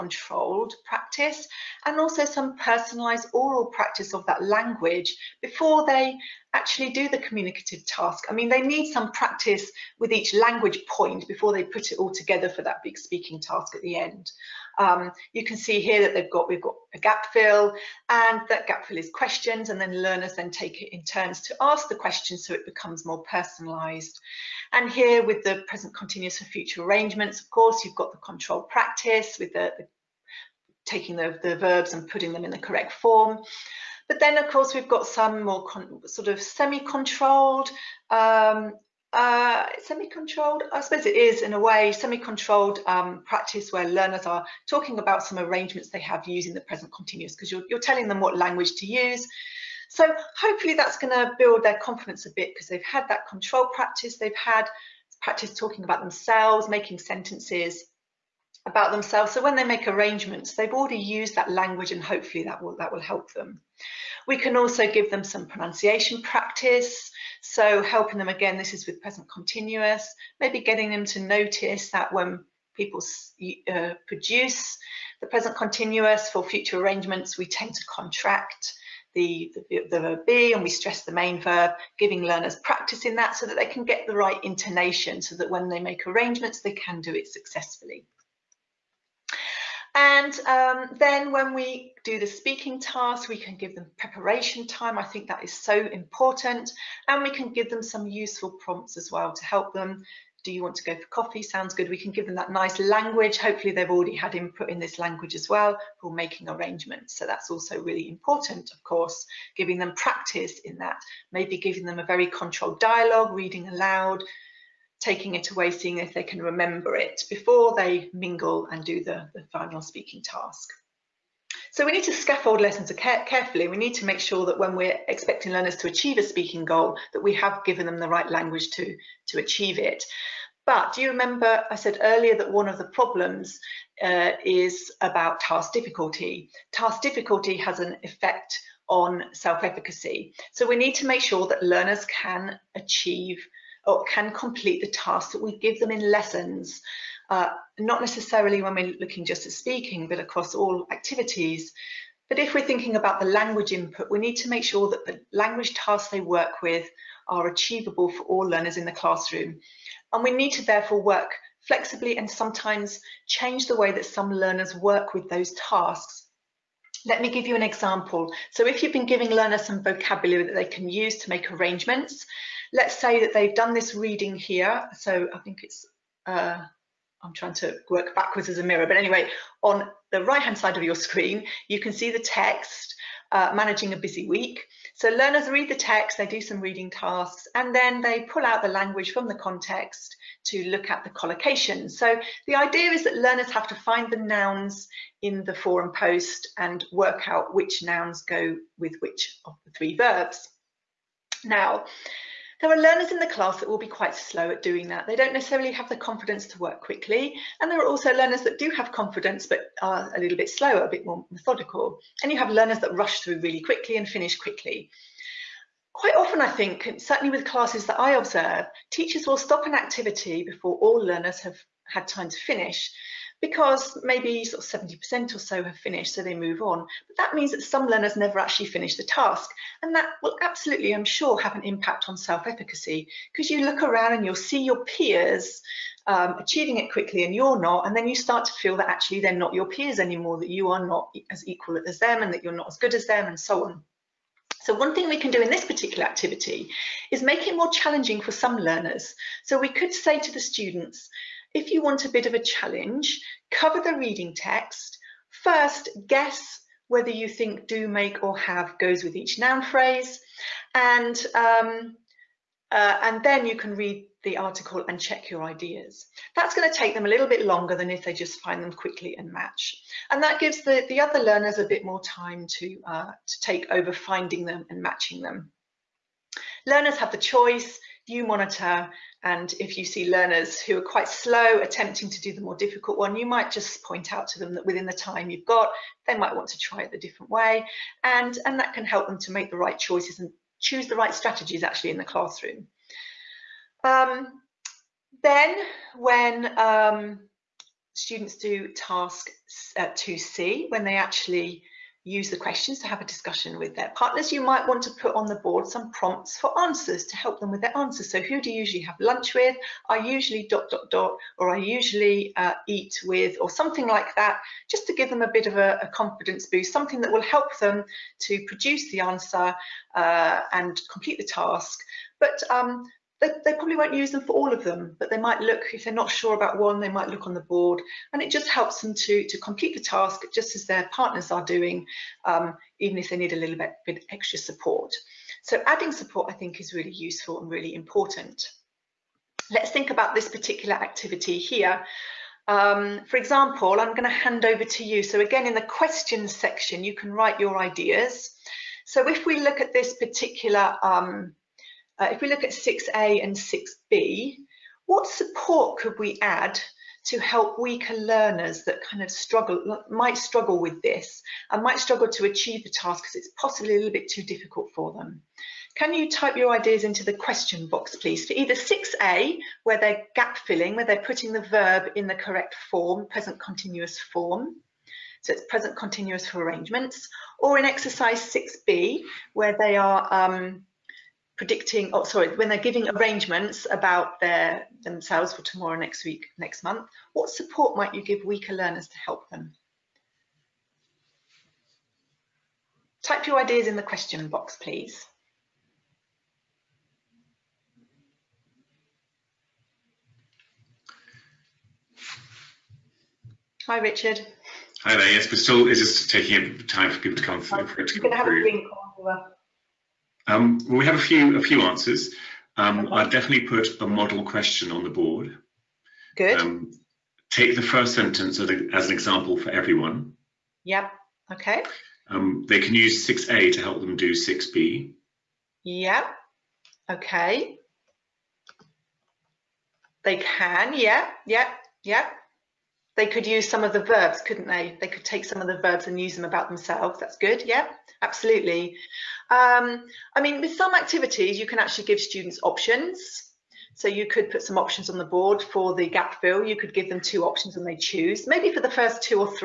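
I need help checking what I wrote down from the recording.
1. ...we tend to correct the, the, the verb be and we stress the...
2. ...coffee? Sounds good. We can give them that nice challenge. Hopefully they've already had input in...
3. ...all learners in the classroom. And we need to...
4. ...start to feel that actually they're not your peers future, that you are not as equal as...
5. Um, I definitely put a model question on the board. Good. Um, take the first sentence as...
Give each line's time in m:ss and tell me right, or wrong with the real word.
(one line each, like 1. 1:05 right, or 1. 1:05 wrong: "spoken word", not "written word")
1. 1:17 wrong: "contract", not "correct"
2. 1:41 wrong: "language", not "challenge"
3. 2:38 right
4. 3:58 wrong: "anymore", not "future"
5. 6:52 right.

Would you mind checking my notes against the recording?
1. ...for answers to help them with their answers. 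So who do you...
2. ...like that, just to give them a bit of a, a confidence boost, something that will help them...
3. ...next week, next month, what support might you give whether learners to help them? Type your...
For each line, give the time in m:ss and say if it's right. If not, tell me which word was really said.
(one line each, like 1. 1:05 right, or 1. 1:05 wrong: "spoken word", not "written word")
1. 5:06 right
2. 5:13 right
3. 6:25 wrong: "weaker", not "whether".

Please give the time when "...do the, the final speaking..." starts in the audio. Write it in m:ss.
1:58.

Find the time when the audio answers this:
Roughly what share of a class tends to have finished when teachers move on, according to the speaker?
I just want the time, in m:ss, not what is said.
3:44.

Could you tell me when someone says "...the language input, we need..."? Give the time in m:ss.
2:33.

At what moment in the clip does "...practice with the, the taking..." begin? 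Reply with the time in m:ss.
0:28.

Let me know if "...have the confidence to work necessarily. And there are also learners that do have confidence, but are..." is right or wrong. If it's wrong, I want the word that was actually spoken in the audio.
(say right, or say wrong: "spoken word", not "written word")
wrong: "quickly", not "necessarily".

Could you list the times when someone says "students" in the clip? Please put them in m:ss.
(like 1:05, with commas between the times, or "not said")
4:10, 4:57, 7:22.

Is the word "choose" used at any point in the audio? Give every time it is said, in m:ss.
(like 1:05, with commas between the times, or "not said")
4:50, 7:27.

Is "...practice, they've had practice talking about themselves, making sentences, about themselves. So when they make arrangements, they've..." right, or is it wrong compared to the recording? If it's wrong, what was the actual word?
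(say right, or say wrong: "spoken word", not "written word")
right.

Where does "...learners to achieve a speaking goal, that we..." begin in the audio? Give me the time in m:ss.
2:05.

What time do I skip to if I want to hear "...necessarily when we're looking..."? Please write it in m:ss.
2:28.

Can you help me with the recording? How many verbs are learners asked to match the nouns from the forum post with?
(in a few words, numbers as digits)
3.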